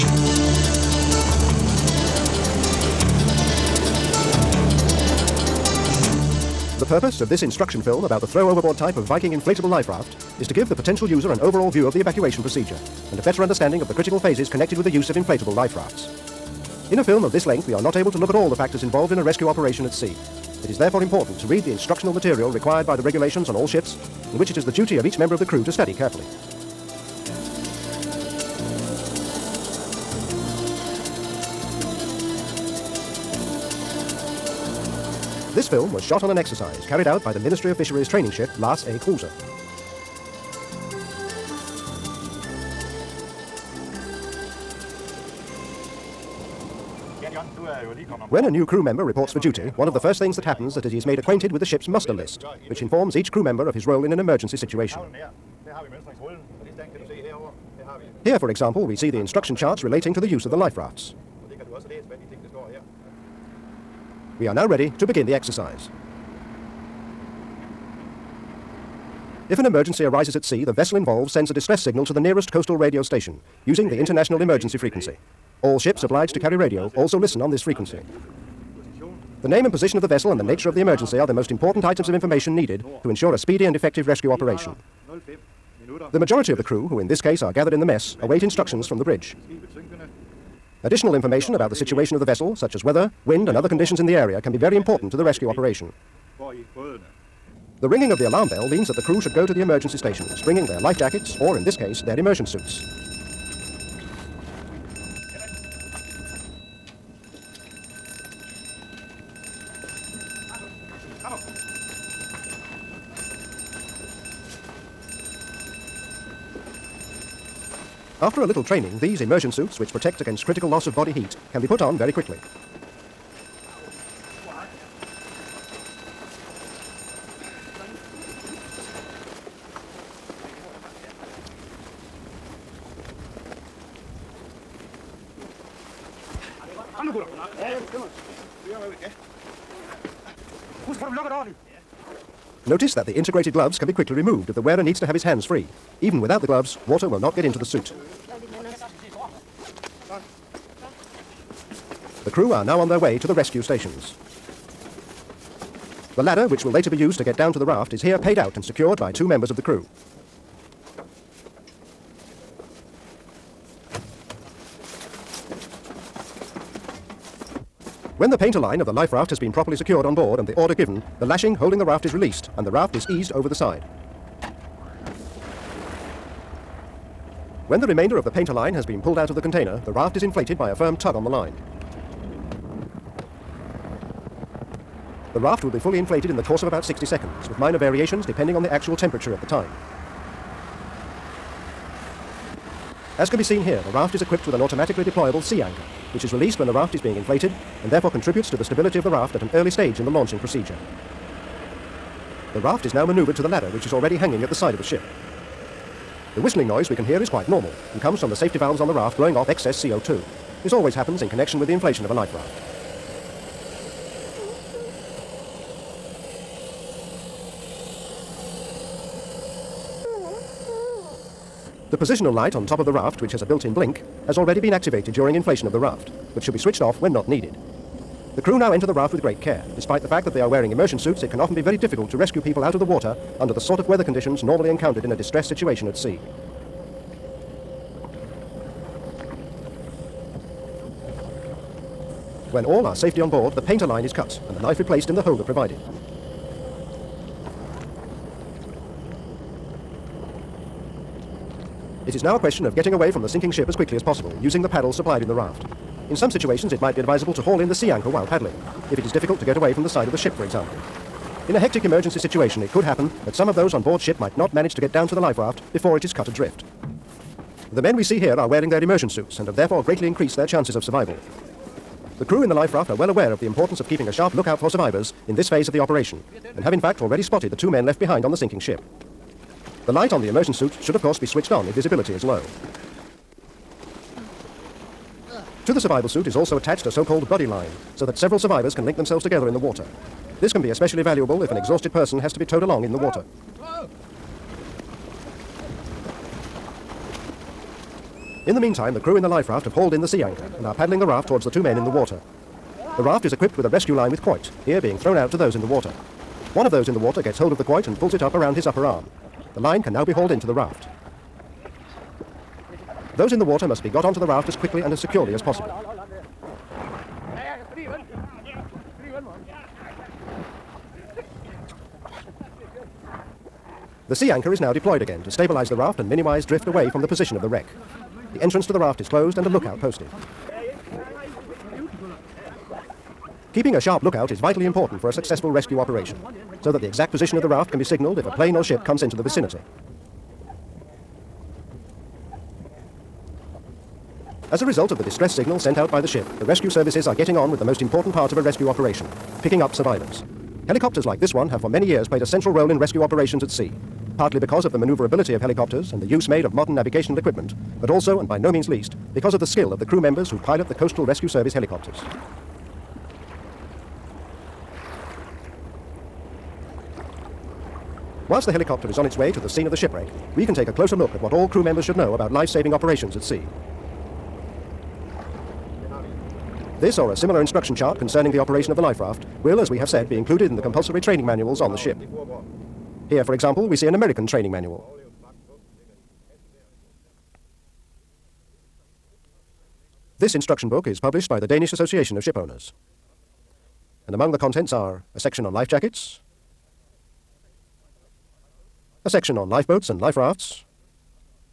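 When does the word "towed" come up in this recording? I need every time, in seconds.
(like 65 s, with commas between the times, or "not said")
292 s.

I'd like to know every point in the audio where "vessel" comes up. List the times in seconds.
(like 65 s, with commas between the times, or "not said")
70 s, 80 s, 92 s.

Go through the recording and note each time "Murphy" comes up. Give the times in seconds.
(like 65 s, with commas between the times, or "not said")
not said.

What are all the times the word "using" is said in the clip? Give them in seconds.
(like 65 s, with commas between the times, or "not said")
73 s, 254 s.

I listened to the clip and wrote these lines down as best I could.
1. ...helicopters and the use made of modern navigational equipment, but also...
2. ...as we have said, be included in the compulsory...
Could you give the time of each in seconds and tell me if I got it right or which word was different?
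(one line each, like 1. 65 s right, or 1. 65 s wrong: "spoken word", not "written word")
1. 355 s right
2. 379 s right.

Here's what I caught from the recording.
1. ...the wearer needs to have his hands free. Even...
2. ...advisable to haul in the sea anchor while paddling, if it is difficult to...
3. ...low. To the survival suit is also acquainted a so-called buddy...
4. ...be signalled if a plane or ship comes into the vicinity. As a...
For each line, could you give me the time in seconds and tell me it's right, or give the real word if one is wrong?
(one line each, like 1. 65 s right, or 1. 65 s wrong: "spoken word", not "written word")
1. 144 s right
2. 257 s right
3. 282 s wrong: "attached", not "acquainted"
4. 337 s right.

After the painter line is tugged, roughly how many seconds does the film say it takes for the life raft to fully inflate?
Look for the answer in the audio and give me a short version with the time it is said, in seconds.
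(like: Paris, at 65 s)
60, at 186 s.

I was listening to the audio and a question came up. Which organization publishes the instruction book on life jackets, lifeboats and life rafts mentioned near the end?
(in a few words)
Danish Association of Shipowners.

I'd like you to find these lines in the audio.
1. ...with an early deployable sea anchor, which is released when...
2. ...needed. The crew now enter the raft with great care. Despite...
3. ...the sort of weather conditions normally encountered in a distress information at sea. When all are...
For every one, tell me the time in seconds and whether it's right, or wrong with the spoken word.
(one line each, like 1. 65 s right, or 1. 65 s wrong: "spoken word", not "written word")
1. 194 s wrong: "automatically", not "early"
2. 227 s right
3. 233 s wrong: "situation", not "information".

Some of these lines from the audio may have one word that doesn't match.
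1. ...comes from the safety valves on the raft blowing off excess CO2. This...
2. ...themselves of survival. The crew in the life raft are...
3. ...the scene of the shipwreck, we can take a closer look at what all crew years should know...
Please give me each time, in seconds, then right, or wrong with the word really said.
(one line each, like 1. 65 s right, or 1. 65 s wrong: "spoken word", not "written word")
1. 208 s right
2. 270 s wrong: "chances", not "themselves"
3. 369 s wrong: "members", not "years".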